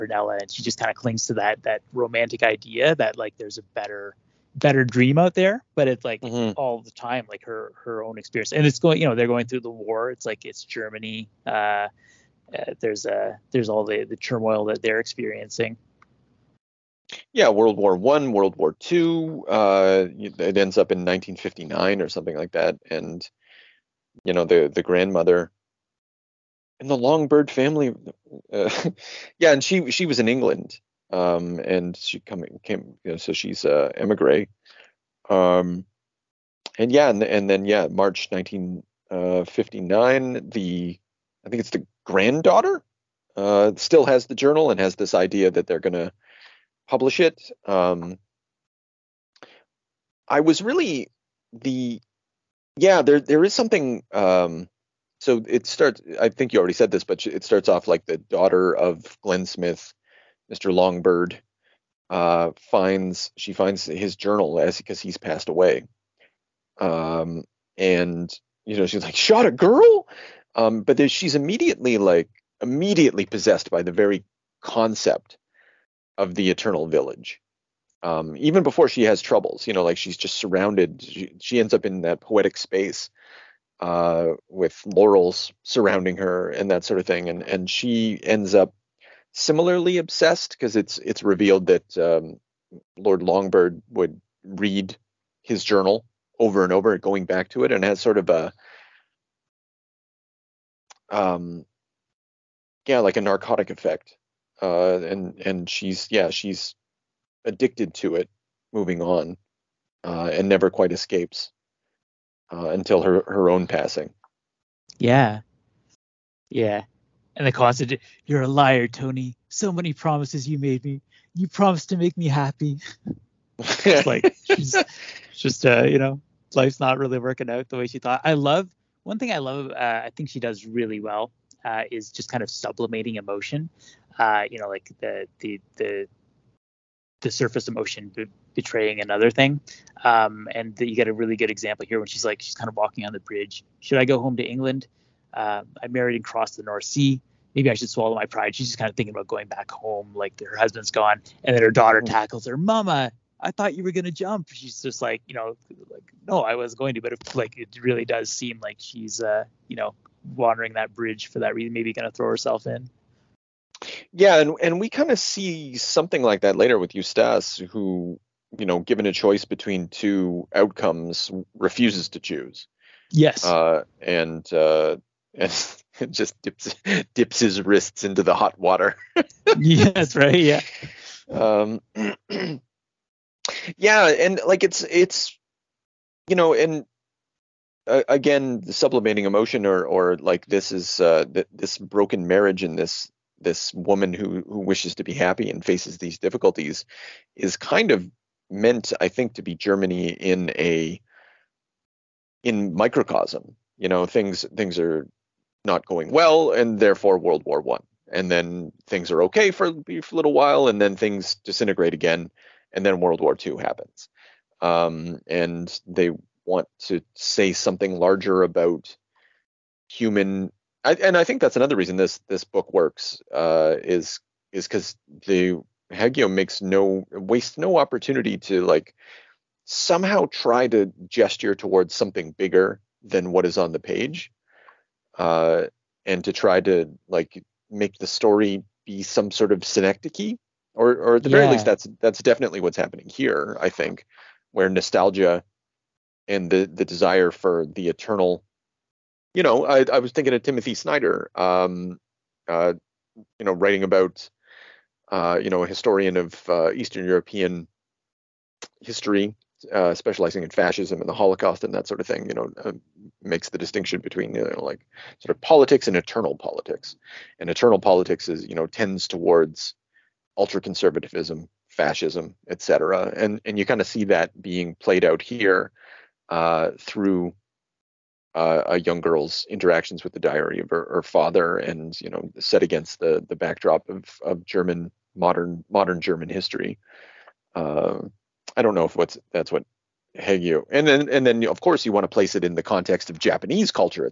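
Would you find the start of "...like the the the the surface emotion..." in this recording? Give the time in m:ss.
2:14.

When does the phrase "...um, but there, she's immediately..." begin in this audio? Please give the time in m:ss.
1:10.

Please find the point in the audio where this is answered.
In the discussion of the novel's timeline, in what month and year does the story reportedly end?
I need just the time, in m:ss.
0:37.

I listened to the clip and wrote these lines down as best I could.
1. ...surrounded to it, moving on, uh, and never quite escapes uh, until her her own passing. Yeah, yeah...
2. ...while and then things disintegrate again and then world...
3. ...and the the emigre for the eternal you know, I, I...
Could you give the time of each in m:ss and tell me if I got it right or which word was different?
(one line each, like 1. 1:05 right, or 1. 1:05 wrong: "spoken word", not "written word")
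1. 1:47 wrong: "addicted", not "surrounded"
2. 3:30 right
3. 4:06 wrong: "desire", not "emigre".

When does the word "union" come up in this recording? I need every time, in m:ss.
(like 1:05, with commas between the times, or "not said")
not said.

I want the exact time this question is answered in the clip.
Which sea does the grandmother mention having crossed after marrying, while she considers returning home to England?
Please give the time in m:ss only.
2:26.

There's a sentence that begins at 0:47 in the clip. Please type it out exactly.
Um, I was really the yeah, there there is something.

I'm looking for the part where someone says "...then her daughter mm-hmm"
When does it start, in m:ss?
2:31.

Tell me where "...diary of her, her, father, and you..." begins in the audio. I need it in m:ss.
4:40.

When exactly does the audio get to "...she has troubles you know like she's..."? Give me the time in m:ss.
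1:18.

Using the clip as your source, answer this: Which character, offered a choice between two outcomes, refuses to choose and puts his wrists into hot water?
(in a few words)
Eustace.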